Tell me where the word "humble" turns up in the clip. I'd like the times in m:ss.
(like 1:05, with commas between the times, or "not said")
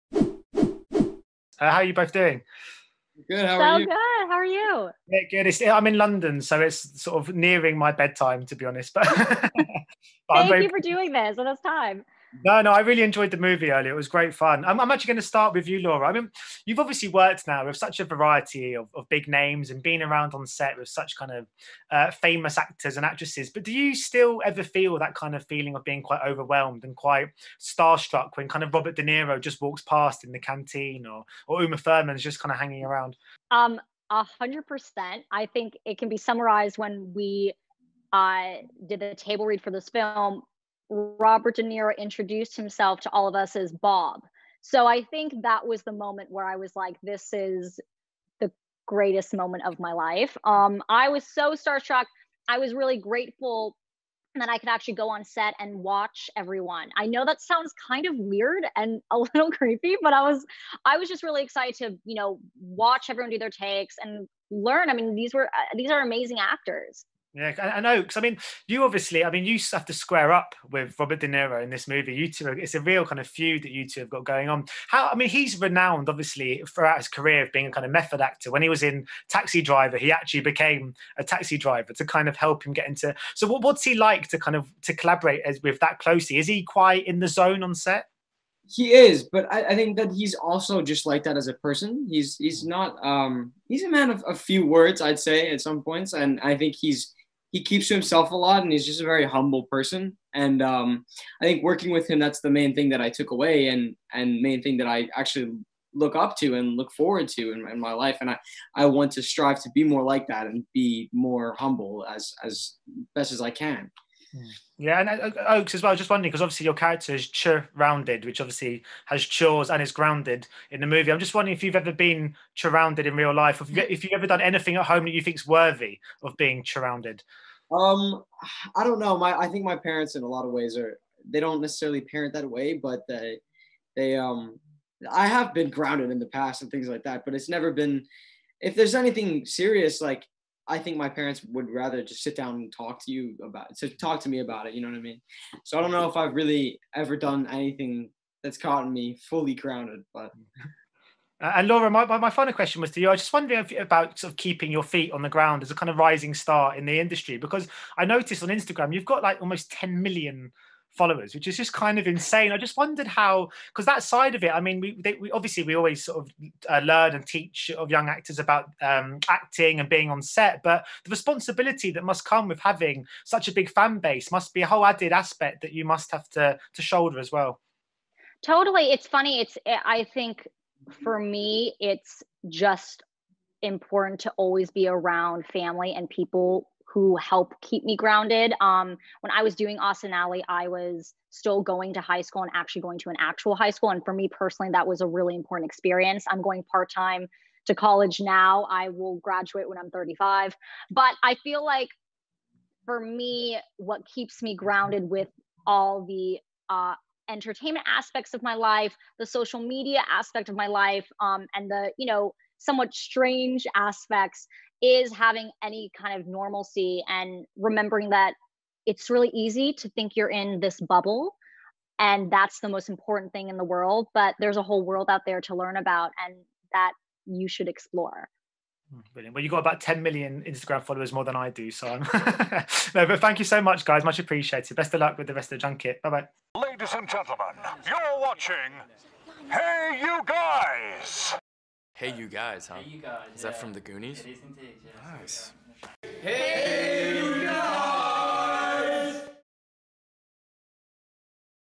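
1:39, 1:51.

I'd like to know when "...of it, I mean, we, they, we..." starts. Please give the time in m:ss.
2:44.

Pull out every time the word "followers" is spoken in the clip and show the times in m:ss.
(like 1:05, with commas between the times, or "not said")
2:40, 3:50.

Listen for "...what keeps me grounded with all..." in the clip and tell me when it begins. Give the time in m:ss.
3:23.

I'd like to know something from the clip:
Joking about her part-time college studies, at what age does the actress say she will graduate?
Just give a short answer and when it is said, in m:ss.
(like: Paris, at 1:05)
35, at 3:19.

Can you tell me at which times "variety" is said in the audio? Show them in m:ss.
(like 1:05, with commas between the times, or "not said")
0:18.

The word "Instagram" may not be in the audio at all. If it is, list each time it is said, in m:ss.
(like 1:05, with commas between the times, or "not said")
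2:38, 3:50.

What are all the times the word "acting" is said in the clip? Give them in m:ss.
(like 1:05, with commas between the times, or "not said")
2:49.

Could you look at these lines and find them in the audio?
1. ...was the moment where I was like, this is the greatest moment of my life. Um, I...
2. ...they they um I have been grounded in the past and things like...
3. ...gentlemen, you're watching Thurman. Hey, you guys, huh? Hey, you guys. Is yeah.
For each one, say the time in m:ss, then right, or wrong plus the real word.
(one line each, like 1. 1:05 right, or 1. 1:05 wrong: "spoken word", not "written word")
1. 0:45 right
2. 2:13 right
3. 3:57 wrong: "HeyUGuys", not "Thurman".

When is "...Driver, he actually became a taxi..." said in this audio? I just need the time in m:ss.
1:19.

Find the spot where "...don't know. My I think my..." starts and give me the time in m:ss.
2:08.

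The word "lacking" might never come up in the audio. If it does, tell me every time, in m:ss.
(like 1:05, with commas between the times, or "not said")
not said.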